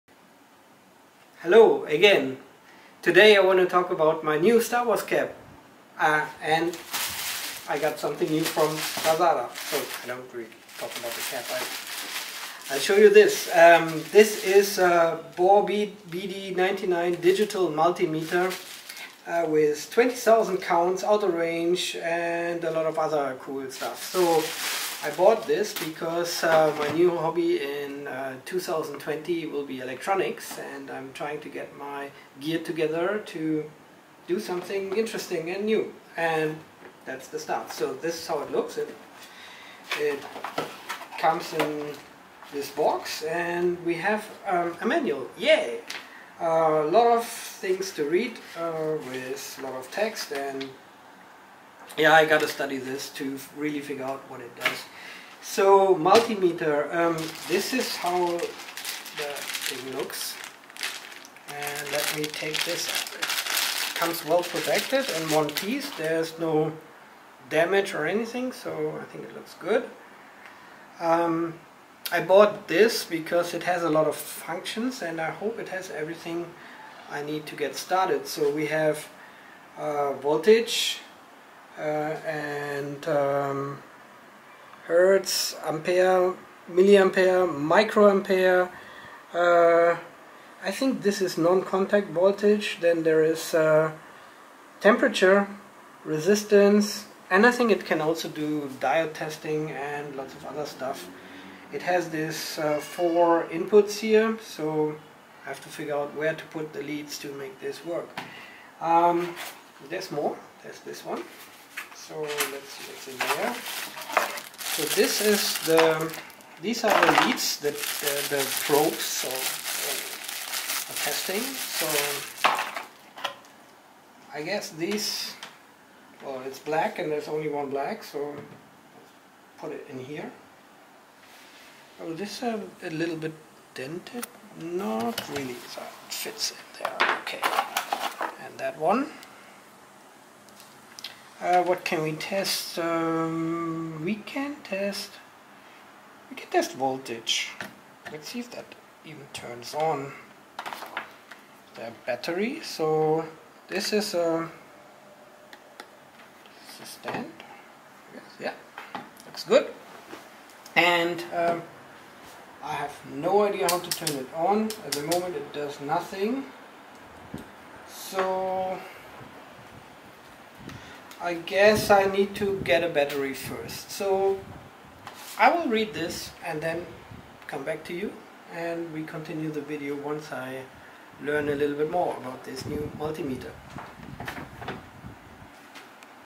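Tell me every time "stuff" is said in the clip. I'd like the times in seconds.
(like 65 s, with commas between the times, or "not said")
23 s, 100 s.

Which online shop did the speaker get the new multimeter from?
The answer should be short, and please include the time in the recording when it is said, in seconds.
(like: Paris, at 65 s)
Lazada, at 9 s.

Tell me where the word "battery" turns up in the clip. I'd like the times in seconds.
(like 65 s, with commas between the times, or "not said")
152 s, 172 s.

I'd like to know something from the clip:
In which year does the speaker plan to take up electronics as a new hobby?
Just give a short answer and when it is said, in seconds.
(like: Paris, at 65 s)
2020, at 28 s.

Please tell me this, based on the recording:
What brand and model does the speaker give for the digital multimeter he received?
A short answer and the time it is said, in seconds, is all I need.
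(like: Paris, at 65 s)
Borbede BD99, at 15 s.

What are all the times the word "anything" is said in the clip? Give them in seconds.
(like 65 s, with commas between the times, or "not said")
68 s.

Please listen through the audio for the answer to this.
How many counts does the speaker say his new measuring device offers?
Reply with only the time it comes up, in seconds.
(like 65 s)
19 s.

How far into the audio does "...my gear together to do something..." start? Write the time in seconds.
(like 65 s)
31 s.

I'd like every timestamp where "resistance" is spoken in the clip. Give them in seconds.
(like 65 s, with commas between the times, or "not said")
96 s.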